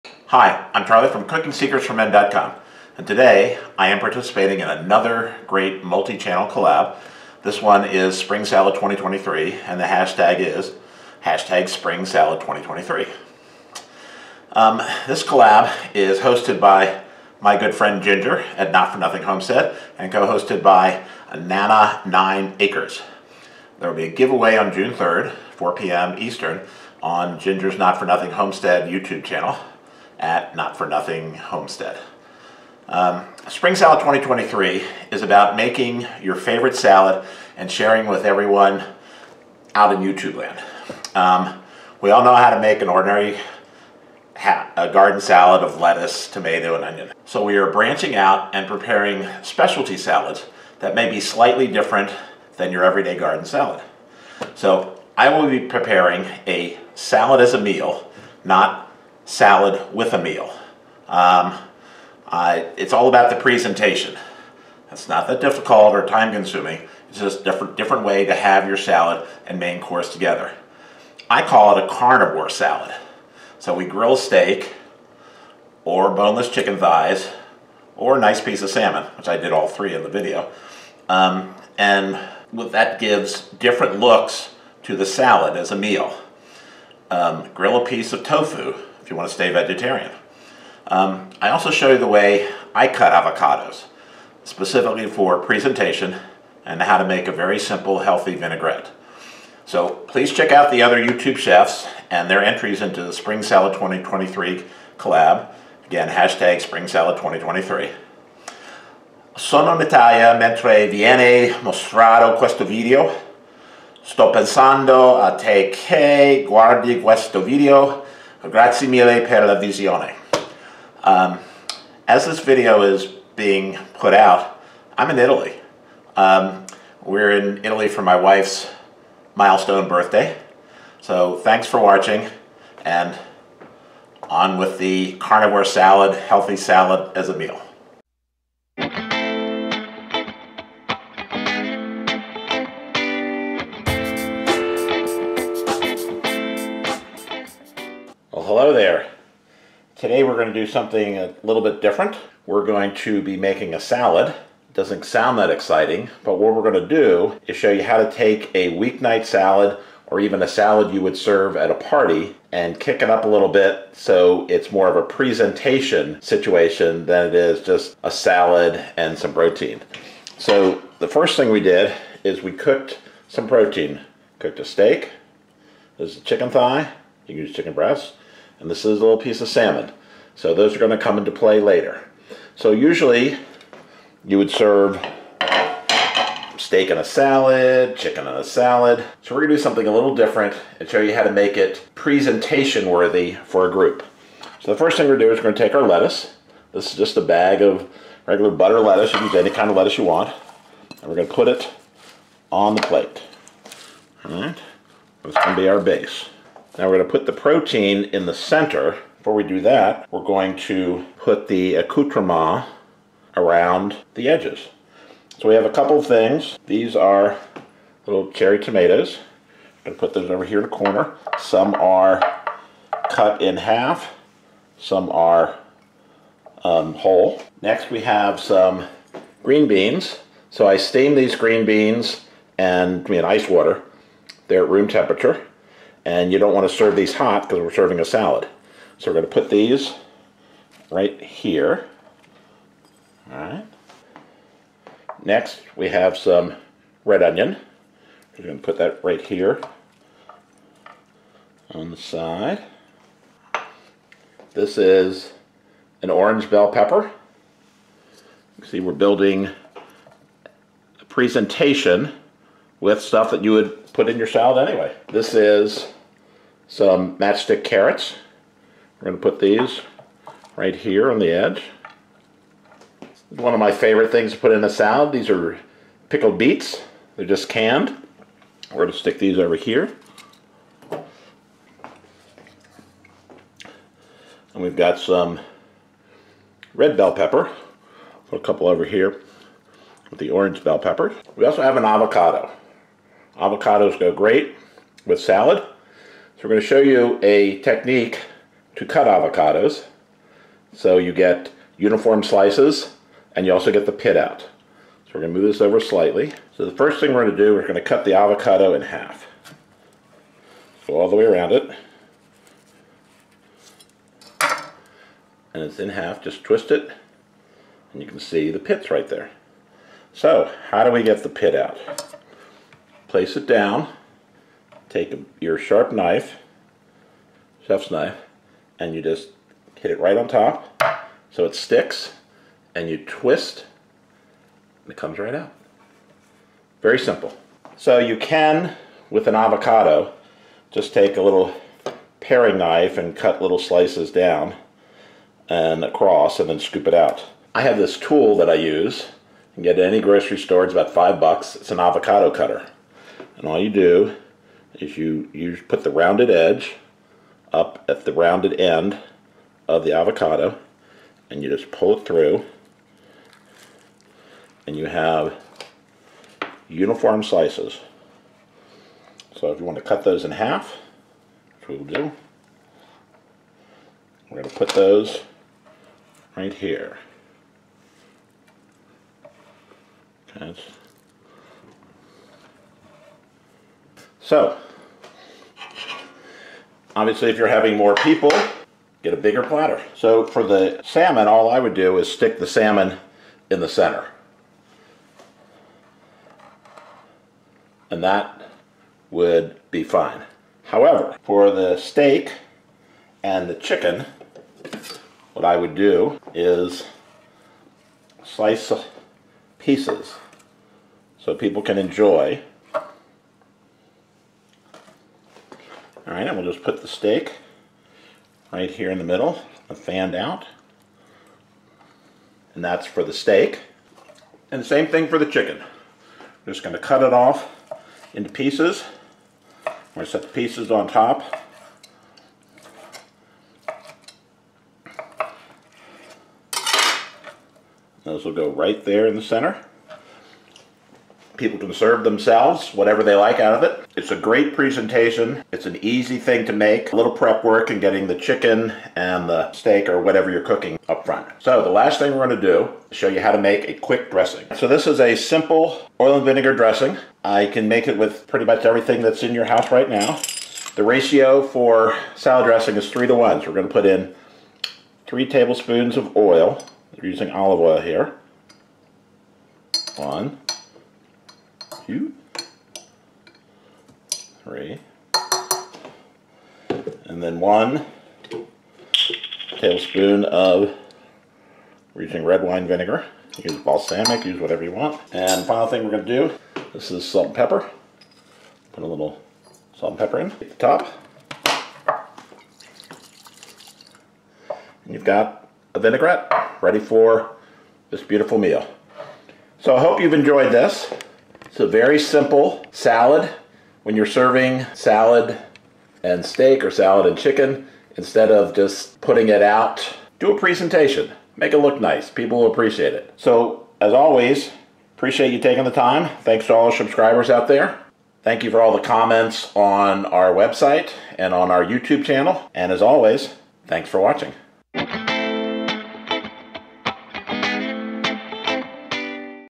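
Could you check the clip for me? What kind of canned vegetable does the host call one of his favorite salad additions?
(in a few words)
pickled beets.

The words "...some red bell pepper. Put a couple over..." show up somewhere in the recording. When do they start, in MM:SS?
04:44.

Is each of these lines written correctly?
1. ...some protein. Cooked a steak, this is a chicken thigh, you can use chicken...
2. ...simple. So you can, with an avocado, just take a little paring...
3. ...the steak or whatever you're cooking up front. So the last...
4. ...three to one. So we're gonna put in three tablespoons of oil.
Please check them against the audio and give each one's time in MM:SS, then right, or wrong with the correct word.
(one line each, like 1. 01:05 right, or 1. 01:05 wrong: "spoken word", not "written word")
1. 02:53 right
2. 05:36 right
3. 07:29 right
4. 07:42 right.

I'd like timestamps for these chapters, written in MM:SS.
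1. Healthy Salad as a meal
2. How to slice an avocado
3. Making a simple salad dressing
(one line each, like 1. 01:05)
1. 02:30
2. 05:00
3. 07:30.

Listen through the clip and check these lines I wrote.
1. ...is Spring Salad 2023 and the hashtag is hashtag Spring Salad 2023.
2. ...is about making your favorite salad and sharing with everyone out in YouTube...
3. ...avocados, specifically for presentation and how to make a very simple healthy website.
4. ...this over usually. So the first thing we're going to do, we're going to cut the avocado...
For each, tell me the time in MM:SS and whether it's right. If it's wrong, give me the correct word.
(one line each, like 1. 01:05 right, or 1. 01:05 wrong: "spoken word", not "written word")
1. 00:07 right
2. 00:35 right
3. 01:33 wrong: "vinaigrette", not "website"
4. 05:05 wrong: "slightly", not "usually".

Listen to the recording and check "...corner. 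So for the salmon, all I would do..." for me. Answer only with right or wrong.
wrong.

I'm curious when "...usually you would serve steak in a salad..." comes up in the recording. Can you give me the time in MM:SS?
03:02.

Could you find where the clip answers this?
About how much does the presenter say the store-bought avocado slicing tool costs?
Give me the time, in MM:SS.
05:50.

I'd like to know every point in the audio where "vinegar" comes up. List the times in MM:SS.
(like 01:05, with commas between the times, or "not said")
07:36, 08:02.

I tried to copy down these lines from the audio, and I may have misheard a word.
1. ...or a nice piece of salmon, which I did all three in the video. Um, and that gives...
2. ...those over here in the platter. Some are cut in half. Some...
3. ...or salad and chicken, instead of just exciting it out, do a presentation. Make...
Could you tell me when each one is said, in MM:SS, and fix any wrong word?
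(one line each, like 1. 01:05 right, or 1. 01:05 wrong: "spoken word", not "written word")
1. 01:17 right
2. 03:40 wrong: "corner", not "platter"
3. 08:26 wrong: "putting", not "exciting".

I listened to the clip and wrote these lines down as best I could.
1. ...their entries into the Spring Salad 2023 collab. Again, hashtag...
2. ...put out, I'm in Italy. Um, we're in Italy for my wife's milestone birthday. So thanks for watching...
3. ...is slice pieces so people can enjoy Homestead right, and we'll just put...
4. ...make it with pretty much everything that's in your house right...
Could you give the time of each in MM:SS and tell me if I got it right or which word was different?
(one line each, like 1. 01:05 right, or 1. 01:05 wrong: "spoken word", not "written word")
1. 01:42 right
2. 02:03 right
3. 06:46 wrong: "All", not "Homestead"
4. 07:37 right.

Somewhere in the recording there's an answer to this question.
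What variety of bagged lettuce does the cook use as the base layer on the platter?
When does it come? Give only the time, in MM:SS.
03:18.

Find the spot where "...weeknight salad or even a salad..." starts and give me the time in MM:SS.
02:38.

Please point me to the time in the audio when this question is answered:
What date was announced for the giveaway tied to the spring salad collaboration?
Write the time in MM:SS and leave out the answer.
00:24.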